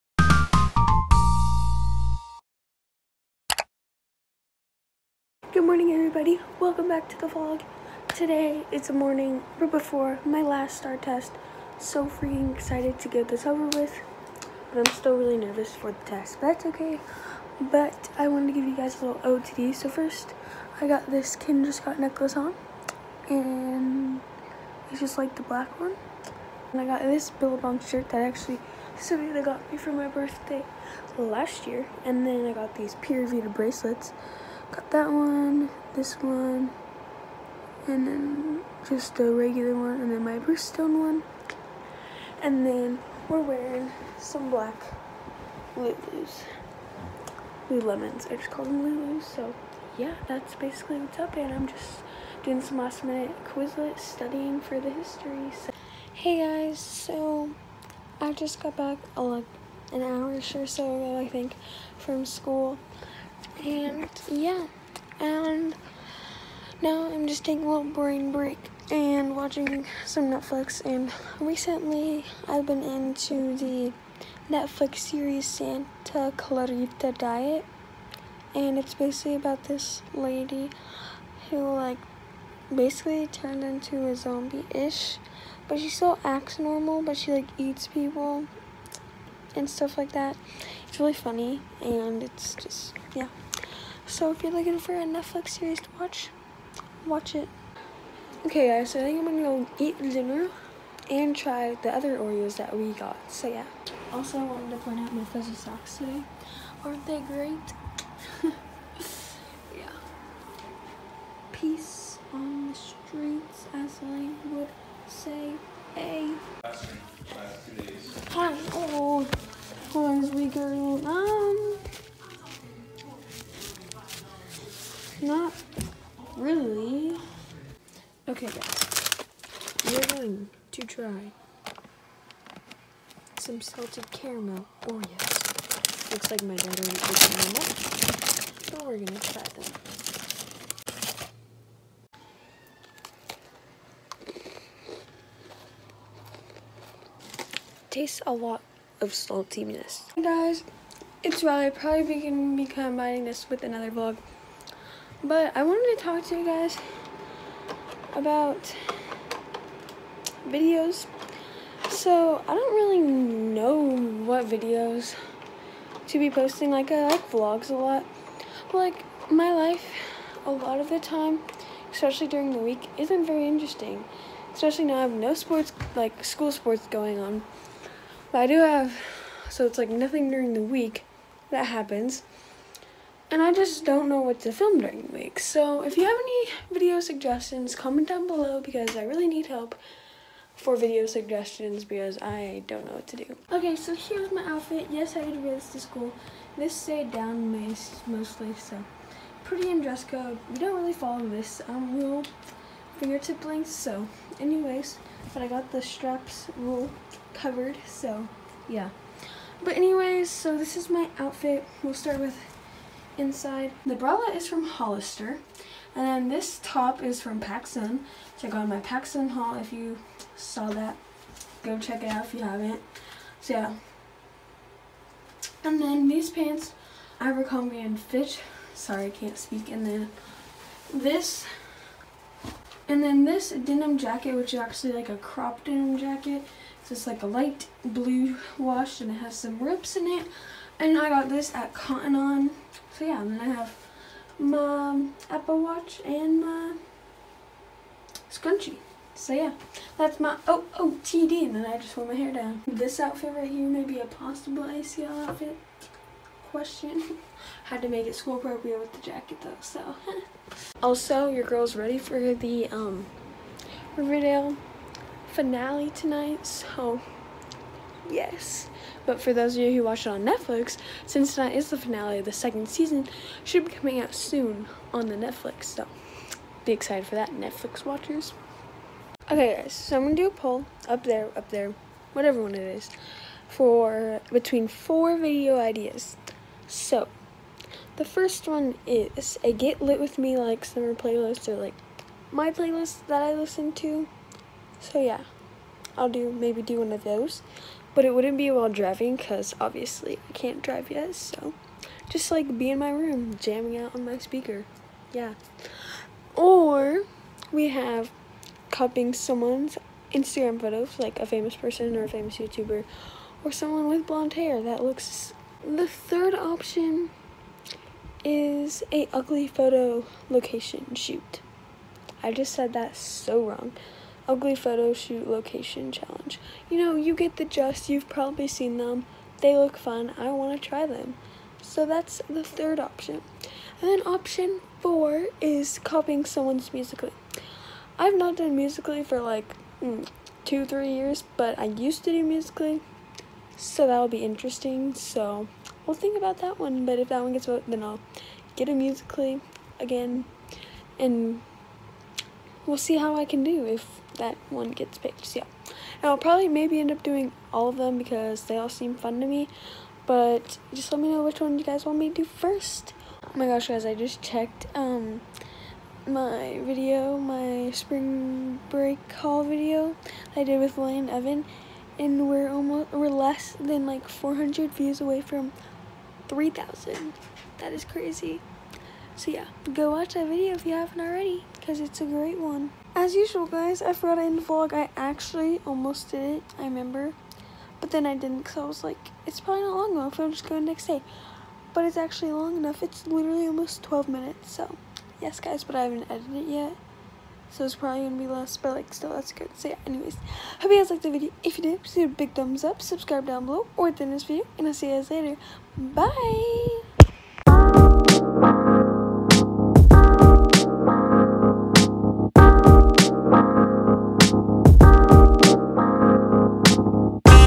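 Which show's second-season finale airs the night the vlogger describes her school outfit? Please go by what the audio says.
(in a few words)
Riverdale.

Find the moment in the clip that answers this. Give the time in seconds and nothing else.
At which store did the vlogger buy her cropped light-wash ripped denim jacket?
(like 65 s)
241 s.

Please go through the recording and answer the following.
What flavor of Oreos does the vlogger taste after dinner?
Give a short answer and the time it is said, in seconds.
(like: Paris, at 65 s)
Salted caramel, at 133 s.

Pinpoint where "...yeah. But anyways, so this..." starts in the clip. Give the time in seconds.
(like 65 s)
208 s.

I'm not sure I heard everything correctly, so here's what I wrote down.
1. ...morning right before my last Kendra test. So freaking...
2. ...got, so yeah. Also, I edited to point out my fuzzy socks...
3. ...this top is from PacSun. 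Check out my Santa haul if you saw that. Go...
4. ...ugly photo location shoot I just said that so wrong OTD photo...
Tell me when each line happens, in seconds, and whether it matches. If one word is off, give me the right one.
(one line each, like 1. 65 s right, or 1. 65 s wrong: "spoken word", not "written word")
1. 8 s wrong: "STAAR", not "Kendra"
2. 102 s wrong: "wanted", not "edited"
3. 216 s wrong: "PacSun", not "Santa"
4. 319 s wrong: "Ugly", not "OTD".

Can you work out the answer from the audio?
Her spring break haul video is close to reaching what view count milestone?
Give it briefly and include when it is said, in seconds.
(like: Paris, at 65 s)
3,000, at 376 s.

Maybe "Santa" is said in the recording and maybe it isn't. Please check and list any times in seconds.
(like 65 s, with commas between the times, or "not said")
75 s.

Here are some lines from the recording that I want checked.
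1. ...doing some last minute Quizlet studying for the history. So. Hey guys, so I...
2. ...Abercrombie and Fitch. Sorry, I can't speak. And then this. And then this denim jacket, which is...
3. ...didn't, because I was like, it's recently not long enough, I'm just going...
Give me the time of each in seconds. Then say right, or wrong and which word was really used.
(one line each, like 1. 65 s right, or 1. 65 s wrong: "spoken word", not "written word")
1. 52 s right
2. 227 s right
3. 388 s wrong: "probably", not "recently".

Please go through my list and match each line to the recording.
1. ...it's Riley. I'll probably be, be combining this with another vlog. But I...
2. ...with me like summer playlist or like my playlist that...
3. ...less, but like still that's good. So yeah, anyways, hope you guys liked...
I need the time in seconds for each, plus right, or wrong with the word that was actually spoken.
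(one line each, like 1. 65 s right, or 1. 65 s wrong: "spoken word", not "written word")
1. 151 s right
2. 289 s right
3. 398 s right.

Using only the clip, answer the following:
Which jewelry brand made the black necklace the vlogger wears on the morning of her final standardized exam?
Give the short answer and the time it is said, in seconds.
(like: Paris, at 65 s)
Kendra Scott, at 21 s.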